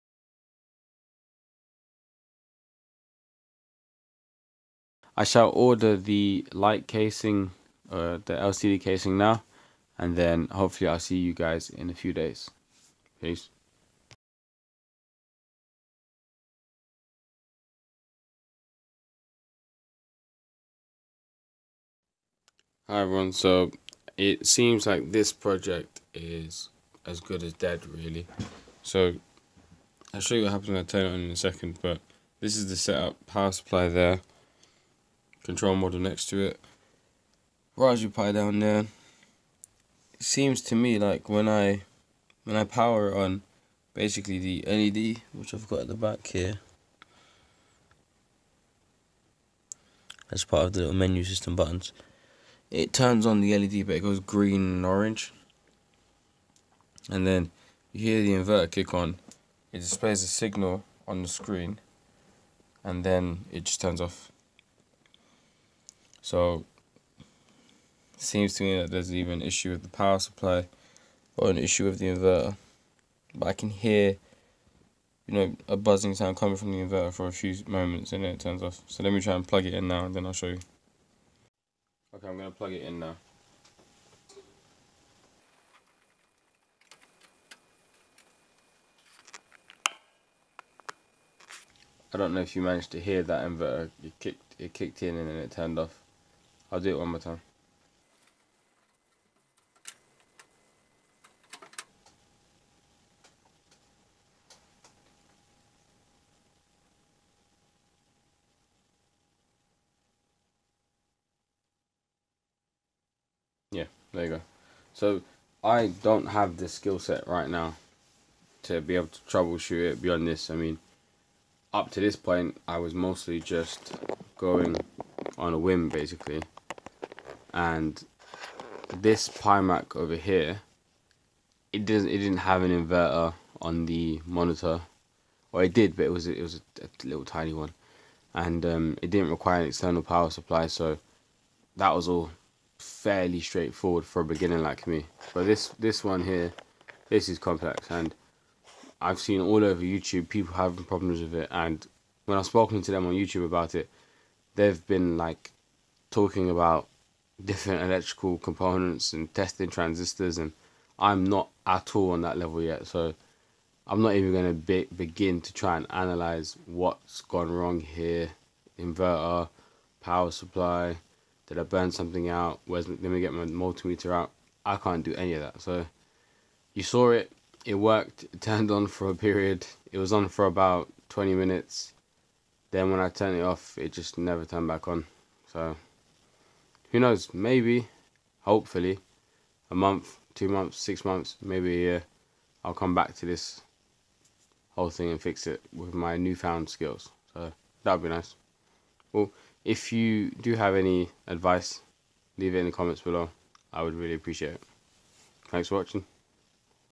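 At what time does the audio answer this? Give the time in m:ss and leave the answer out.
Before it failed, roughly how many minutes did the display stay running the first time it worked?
3:01.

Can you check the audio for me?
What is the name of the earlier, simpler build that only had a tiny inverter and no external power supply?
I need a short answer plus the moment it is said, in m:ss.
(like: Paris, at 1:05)
PiMac, at 2:09.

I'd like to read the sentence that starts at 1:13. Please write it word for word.
But I can hear, you know, a buzzing sound coming from the inverter for a few moments and then it turns off.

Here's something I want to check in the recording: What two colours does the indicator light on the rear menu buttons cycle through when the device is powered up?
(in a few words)
green and orange.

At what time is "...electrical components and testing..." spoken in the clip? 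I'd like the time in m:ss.
2:37.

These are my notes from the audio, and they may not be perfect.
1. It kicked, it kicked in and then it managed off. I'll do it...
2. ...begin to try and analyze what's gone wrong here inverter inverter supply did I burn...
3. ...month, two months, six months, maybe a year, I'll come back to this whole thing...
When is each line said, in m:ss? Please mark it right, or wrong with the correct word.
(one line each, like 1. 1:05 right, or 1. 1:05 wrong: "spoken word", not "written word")
1. 1:34 wrong: "turned", not "managed"
2. 2:44 wrong: "power", not "inverter"
3. 3:09 right.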